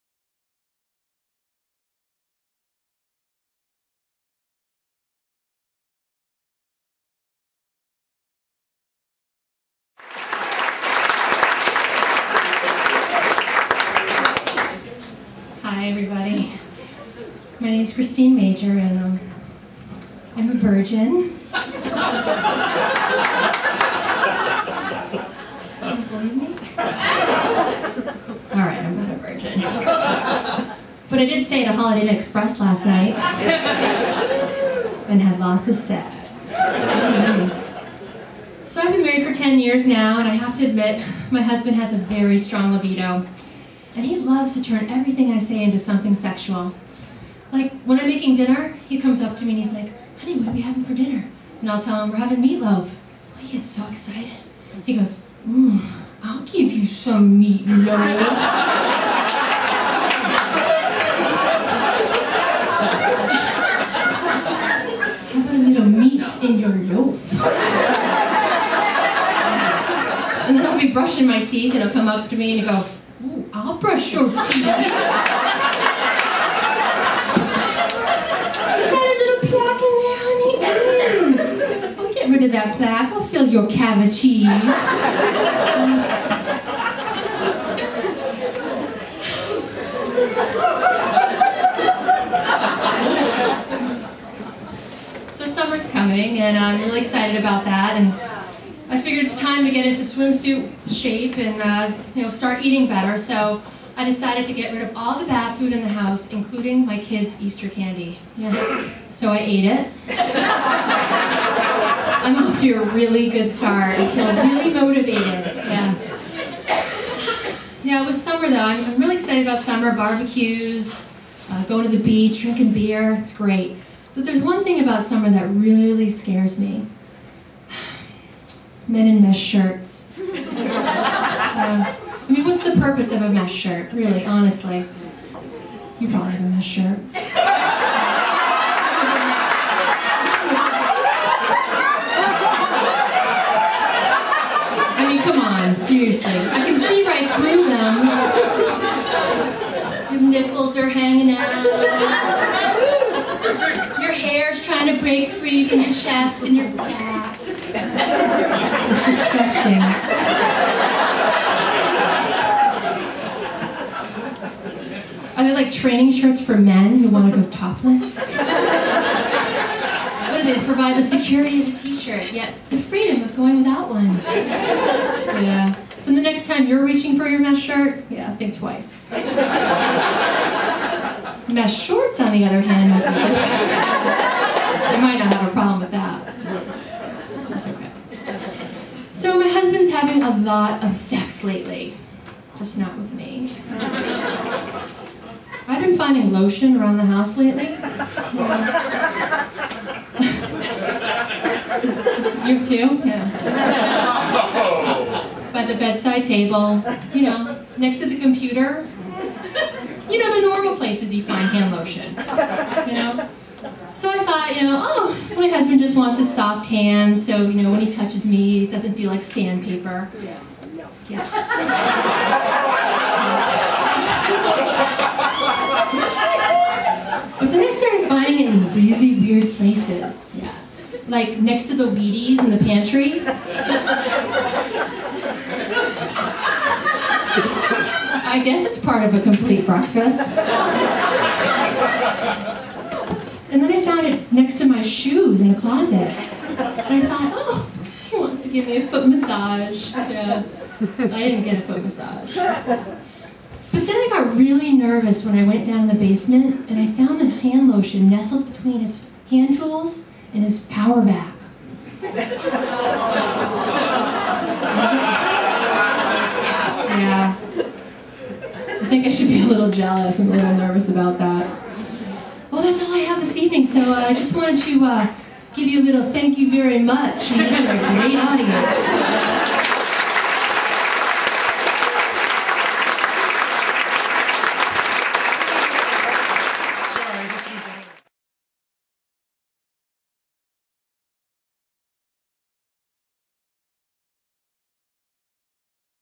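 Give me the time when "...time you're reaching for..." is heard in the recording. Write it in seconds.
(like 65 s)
176 s.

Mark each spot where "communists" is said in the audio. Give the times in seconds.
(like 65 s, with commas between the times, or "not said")
not said.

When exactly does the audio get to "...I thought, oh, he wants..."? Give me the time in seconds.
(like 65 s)
246 s.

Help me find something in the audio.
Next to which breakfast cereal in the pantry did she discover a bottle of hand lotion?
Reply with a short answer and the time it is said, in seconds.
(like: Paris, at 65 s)
Wheaties, at 231 s.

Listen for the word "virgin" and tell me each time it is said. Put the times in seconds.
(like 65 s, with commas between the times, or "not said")
20 s, 29 s.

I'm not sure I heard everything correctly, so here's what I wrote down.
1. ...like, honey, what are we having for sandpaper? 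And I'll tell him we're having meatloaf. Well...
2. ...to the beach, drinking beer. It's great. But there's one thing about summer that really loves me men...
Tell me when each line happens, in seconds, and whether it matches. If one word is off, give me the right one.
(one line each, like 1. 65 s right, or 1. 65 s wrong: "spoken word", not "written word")
1. 49 s wrong: "dinner", not "sandpaper"
2. 121 s wrong: "scares", not "loves".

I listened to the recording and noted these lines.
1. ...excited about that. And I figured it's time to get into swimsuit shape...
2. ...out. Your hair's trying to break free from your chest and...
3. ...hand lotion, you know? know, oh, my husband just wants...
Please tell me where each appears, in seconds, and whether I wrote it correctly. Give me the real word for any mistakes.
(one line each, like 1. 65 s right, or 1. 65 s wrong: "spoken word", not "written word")
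1. 97 s right
2. 151 s right
3. 211 s right.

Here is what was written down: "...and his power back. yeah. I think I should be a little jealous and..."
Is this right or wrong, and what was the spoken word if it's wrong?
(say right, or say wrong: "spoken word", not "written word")
right.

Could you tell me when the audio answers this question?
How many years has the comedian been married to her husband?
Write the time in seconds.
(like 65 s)
39 s.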